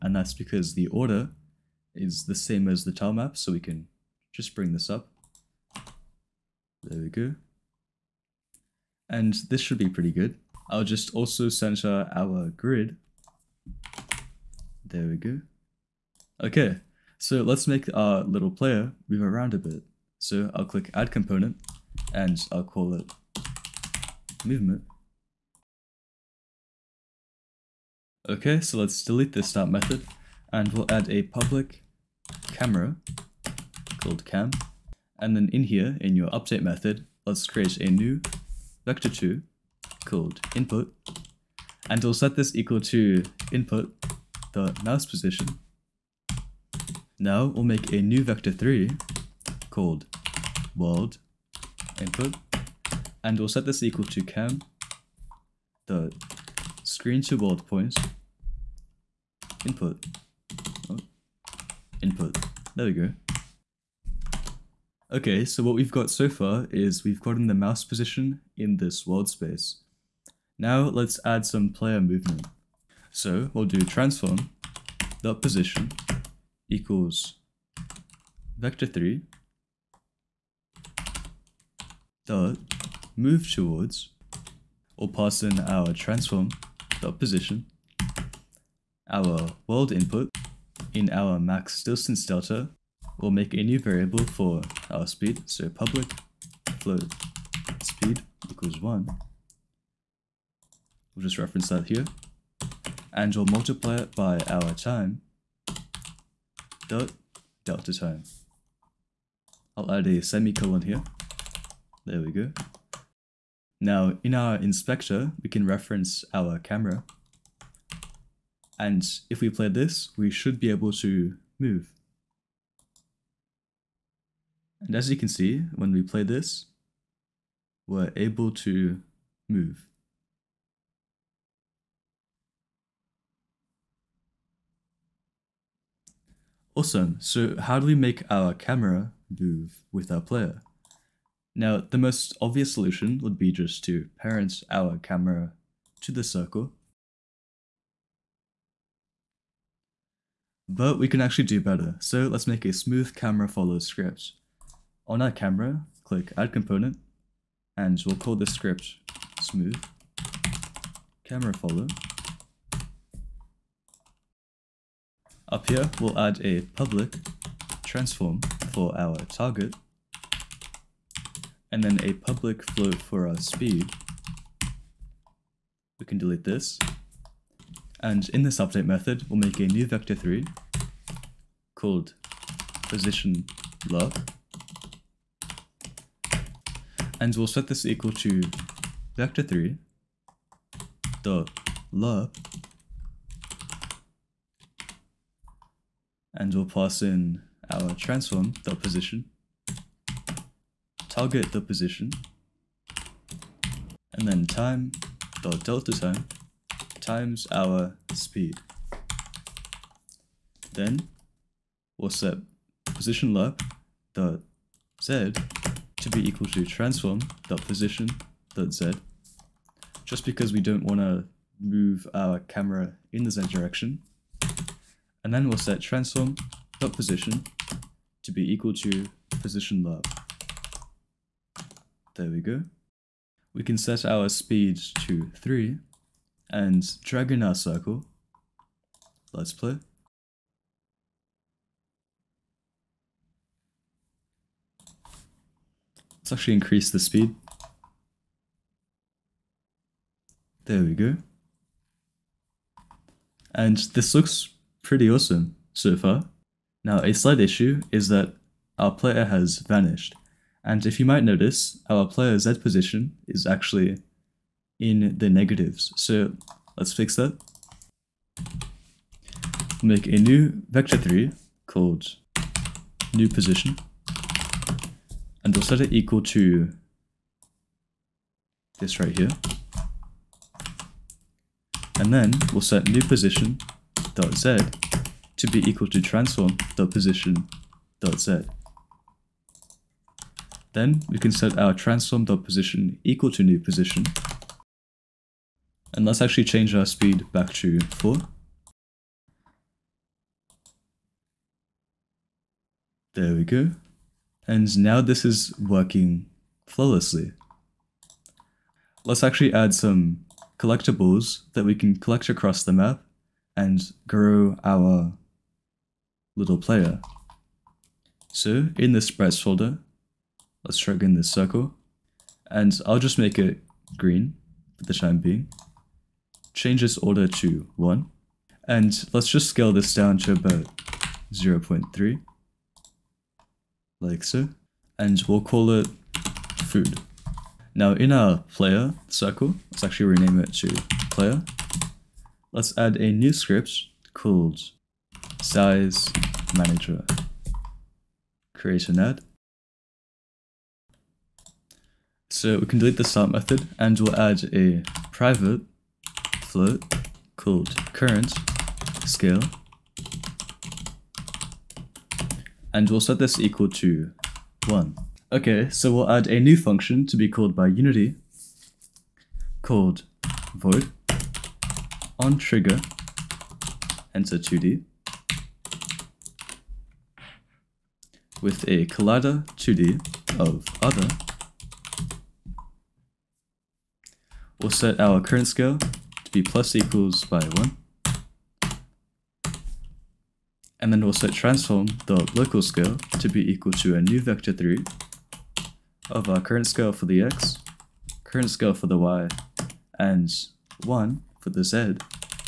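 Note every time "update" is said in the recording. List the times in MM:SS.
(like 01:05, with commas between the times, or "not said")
00:36, 02:58.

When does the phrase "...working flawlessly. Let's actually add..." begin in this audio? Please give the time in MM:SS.
05:05.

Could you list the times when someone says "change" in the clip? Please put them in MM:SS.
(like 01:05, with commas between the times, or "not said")
04:56, 05:26.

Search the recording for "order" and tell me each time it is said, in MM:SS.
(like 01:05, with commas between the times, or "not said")
00:00, 05:26.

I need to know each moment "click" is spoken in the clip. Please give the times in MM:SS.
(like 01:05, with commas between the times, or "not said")
00:20, 02:36.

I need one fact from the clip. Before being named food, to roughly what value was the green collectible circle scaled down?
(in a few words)
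0.3.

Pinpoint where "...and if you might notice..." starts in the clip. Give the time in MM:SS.
04:20.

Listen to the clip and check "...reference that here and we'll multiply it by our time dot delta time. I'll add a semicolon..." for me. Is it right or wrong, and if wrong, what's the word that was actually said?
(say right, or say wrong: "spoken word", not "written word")
right.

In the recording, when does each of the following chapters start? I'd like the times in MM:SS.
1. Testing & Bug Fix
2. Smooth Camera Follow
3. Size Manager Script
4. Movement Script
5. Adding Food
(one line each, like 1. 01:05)
1. 04:03
2. 02:18
3. 05:42
4. 00:22
5. 05:08.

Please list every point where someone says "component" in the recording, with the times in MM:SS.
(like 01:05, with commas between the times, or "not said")
00:21, 02:36.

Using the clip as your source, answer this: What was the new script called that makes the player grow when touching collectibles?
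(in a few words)
size manager.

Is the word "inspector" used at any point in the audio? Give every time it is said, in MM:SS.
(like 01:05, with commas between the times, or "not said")
01:54.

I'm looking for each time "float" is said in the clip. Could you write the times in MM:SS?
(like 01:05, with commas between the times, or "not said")
01:36, 02:52, 05:56.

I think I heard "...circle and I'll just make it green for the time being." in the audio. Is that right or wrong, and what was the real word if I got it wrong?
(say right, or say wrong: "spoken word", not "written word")
right.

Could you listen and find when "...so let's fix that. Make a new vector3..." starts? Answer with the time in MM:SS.
04:25.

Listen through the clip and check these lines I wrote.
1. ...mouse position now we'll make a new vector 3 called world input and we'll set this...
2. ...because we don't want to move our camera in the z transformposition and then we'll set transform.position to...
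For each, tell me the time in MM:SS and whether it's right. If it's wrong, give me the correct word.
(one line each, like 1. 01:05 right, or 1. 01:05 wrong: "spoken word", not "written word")
1. 00:44 right
2. 03:40 wrong: "direction", not "transformposition".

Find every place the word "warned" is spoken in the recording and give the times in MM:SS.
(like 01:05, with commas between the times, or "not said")
not said.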